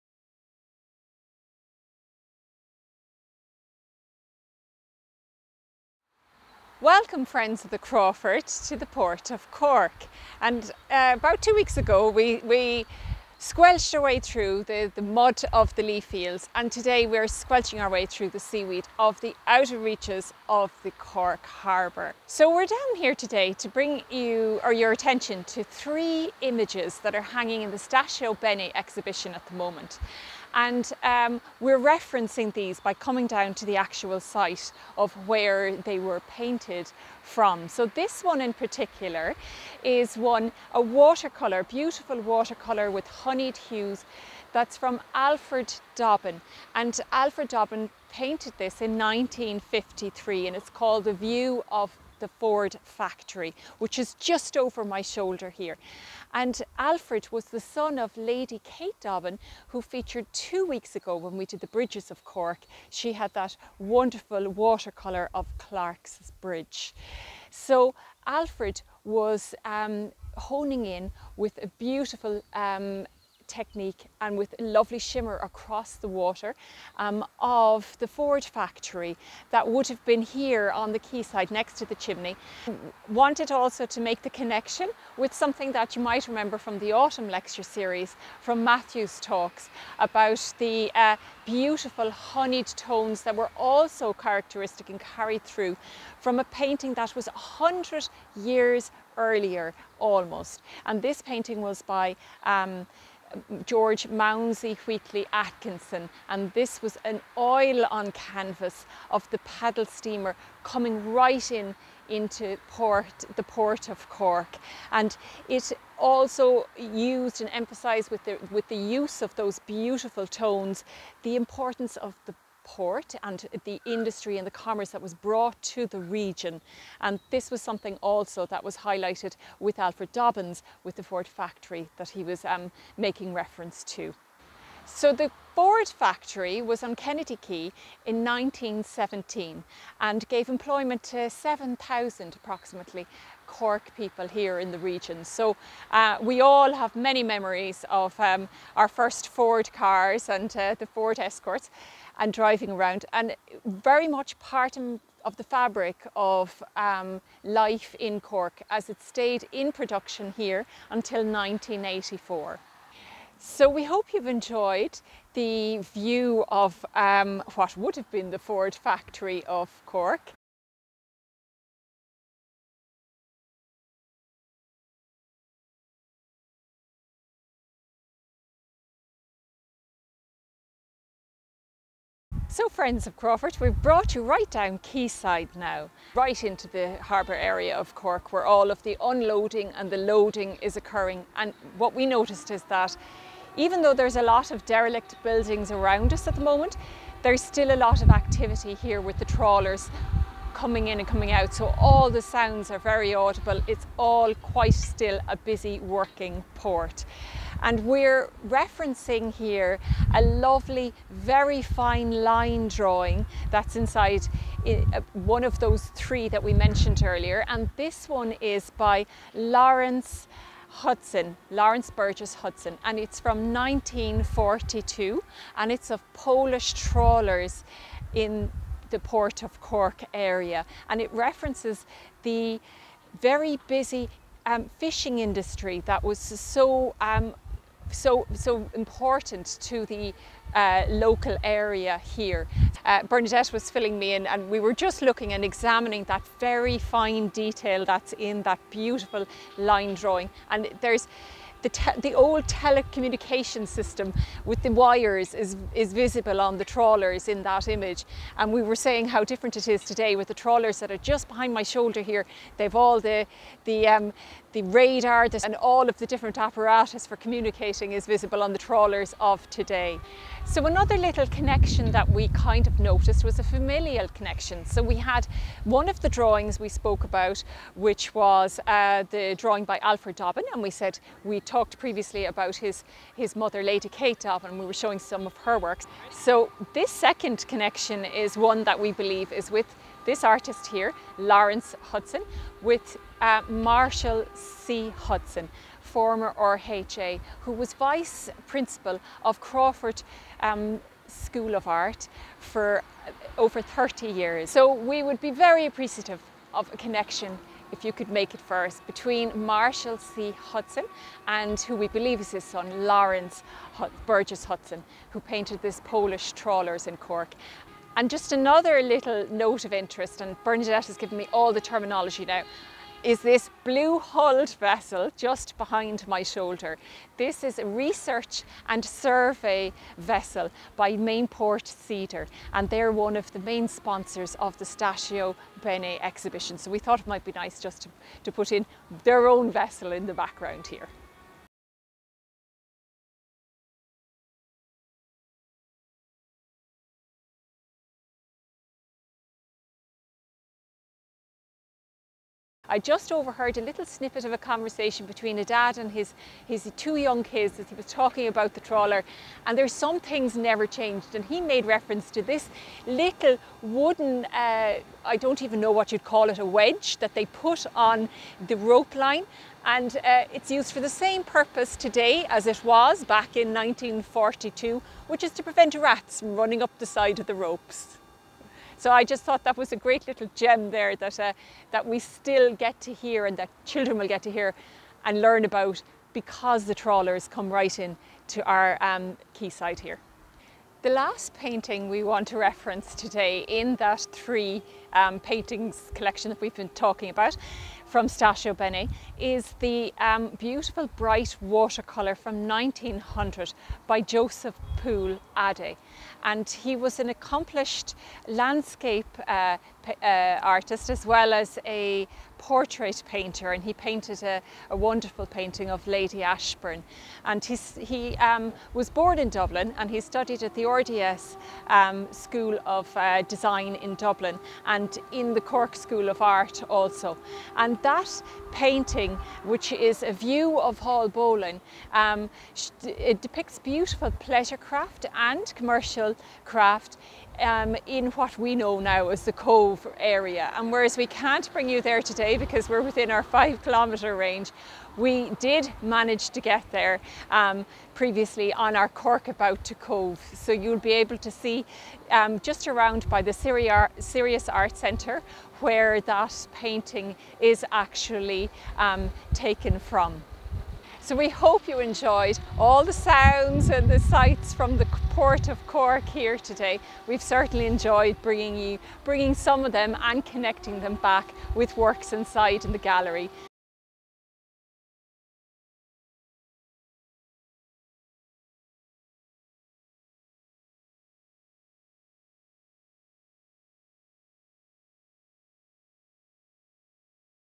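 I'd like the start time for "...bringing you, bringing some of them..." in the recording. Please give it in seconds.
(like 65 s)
468 s.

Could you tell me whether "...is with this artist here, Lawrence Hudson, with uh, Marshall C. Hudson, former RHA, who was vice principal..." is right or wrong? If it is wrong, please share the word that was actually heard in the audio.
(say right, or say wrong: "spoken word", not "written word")
right.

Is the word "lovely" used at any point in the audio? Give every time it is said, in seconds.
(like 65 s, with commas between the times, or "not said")
74 s, 210 s.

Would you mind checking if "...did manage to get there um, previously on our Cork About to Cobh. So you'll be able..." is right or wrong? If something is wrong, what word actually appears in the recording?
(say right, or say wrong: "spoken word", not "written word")
right.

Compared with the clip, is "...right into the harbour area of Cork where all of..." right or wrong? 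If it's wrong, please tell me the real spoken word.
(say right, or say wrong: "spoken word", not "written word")
right.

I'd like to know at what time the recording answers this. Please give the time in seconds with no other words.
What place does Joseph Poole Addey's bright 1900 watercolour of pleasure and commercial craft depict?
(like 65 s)
430 s.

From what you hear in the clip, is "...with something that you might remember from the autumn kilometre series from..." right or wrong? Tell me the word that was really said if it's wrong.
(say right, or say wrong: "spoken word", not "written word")
wrong: "lecture", not "kilometre".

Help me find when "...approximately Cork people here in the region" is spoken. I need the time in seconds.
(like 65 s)
142 s.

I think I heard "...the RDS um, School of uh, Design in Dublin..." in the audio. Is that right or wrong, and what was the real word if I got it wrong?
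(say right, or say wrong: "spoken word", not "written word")
right.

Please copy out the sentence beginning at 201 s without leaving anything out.
So all the sounds are very audible.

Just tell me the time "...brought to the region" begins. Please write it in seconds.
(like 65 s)
125 s.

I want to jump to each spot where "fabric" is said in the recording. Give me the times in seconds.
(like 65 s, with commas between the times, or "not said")
155 s.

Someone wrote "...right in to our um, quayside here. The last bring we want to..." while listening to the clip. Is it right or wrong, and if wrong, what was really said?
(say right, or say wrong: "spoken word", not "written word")
wrong: "painting", not "bring".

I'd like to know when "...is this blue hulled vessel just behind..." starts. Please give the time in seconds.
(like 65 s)
323 s.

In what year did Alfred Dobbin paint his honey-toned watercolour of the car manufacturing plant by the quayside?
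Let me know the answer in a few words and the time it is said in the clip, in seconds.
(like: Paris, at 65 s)
1953, at 48 s.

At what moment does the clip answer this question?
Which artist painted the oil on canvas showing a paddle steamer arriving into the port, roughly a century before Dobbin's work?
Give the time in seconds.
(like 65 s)
103 s.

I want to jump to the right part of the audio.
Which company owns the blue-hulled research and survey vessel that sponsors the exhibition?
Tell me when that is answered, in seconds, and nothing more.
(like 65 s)
330 s.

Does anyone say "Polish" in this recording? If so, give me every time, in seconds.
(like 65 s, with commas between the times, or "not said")
226 s, 315 s.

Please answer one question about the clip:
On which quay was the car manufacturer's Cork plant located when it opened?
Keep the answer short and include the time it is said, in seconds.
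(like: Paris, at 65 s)
Kennedy Quay, at 136 s.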